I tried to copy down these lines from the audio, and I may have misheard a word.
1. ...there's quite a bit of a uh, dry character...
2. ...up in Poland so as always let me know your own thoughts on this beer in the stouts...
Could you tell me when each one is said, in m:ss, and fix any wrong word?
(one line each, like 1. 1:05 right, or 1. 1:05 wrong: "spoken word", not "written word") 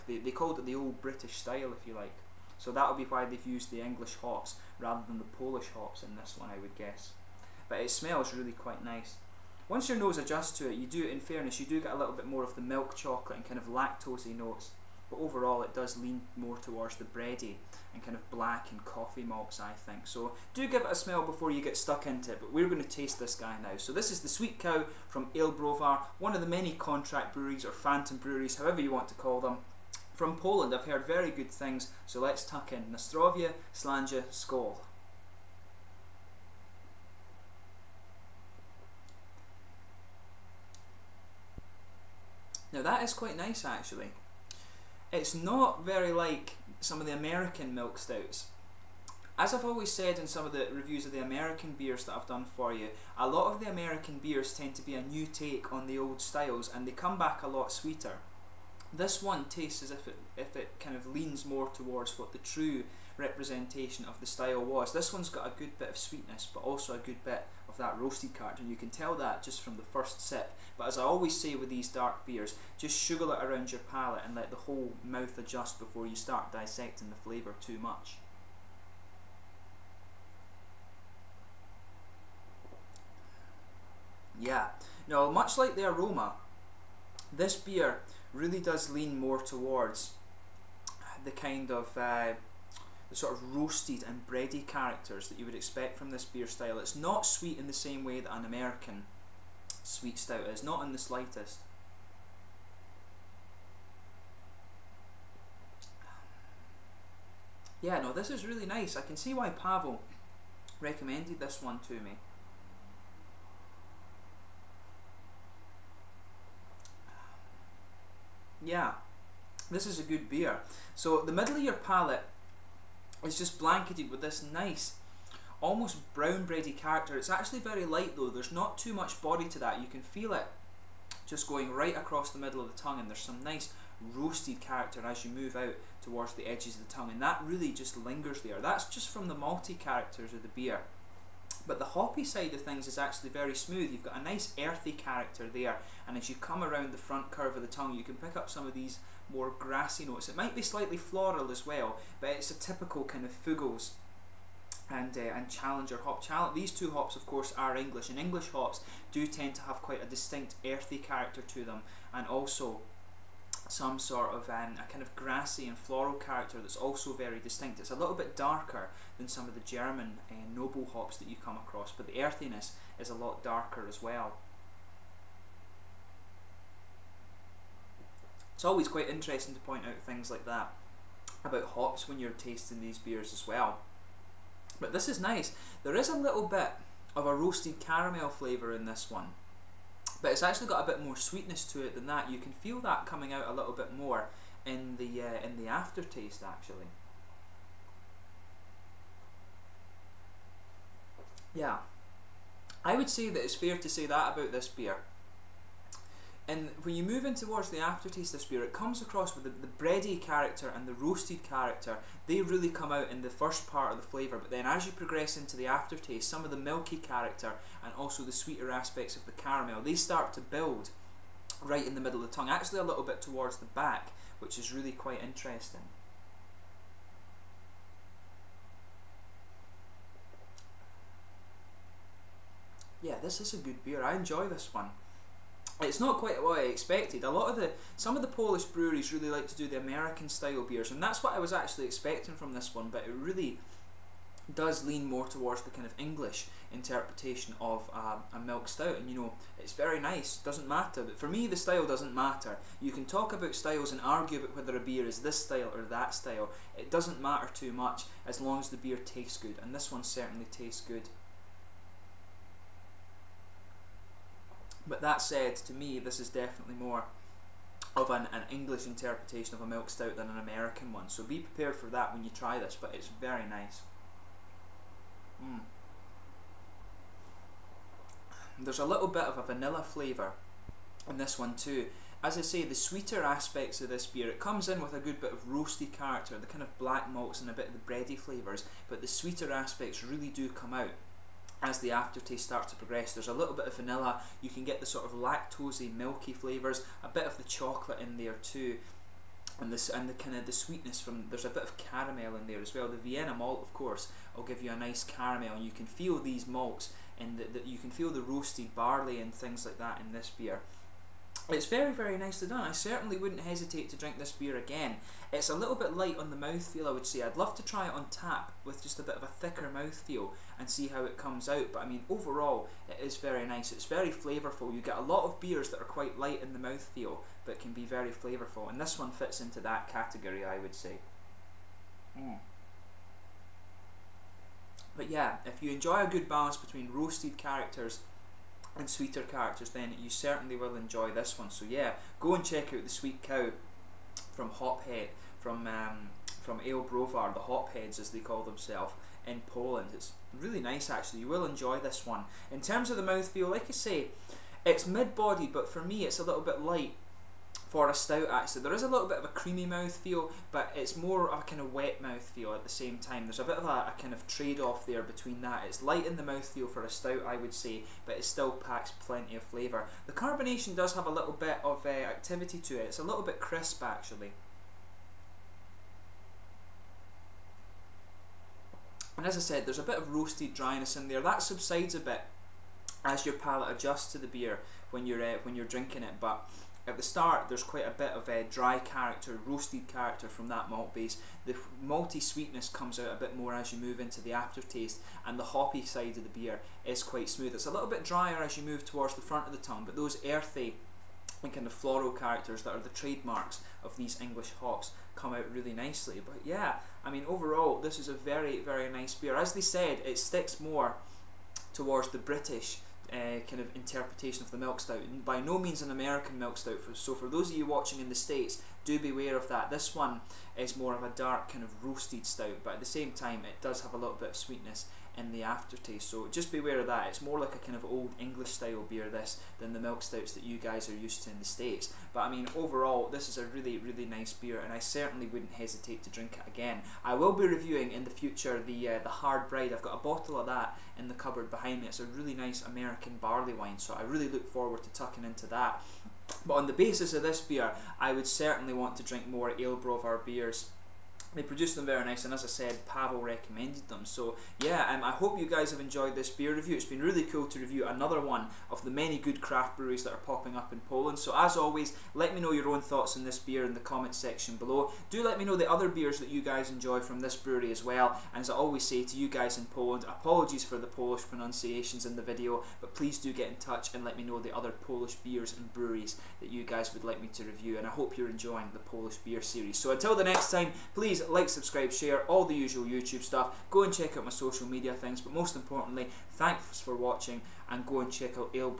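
1. 6:27 right
2. 7:40 wrong: "comments", not "stouts".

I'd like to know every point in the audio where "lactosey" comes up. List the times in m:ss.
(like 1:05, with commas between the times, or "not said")
0:13, 4:55.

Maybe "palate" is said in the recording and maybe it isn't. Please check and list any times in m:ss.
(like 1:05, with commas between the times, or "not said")
1:13, 2:01, 6:23.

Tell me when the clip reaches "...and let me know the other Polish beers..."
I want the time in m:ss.
7:53.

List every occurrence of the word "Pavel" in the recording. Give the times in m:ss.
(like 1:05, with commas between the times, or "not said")
1:49, 7:32.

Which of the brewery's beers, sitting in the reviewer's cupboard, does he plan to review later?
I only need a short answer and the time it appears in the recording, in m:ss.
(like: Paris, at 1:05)
Hard Bride, at 7:19.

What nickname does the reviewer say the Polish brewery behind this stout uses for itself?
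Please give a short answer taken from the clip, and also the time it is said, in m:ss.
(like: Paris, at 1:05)
Hopheads, at 5:47.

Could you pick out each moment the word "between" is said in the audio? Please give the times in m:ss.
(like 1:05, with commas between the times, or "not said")
5:36, 6:05.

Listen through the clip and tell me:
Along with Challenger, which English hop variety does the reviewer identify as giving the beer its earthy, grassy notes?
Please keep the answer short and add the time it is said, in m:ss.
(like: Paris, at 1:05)
Fuggles, at 2:33.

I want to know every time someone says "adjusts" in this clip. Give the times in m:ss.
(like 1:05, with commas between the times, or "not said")
0:10, 1:15, 6:23.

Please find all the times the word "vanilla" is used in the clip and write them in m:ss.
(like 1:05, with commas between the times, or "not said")
4:39, 4:53.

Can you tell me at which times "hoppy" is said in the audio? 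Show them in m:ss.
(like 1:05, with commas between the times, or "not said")
2:21, 6:35.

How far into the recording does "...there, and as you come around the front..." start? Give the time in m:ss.
2:25.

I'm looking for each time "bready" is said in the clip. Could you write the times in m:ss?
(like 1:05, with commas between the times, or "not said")
0:17, 1:34, 2:06, 3:29, 4:47.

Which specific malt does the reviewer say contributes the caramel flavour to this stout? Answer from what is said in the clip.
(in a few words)
Vienna malt.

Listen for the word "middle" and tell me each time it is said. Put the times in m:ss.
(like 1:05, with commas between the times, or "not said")
2:01, 2:12, 3:41.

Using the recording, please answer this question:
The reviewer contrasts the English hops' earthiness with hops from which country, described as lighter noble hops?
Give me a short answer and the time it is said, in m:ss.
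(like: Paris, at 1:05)
German, at 2:49.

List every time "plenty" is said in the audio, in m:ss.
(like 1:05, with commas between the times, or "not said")
6:08.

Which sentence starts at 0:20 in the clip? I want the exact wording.
So do give it a smell before you get stuck into it, but we're going to taste this guy now.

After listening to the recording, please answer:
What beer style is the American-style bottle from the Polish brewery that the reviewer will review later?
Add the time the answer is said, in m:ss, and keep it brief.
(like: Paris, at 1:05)
Barley wine, at 7:23.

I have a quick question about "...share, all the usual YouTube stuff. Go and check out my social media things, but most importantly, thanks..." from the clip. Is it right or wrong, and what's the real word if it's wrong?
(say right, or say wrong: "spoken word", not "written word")
right.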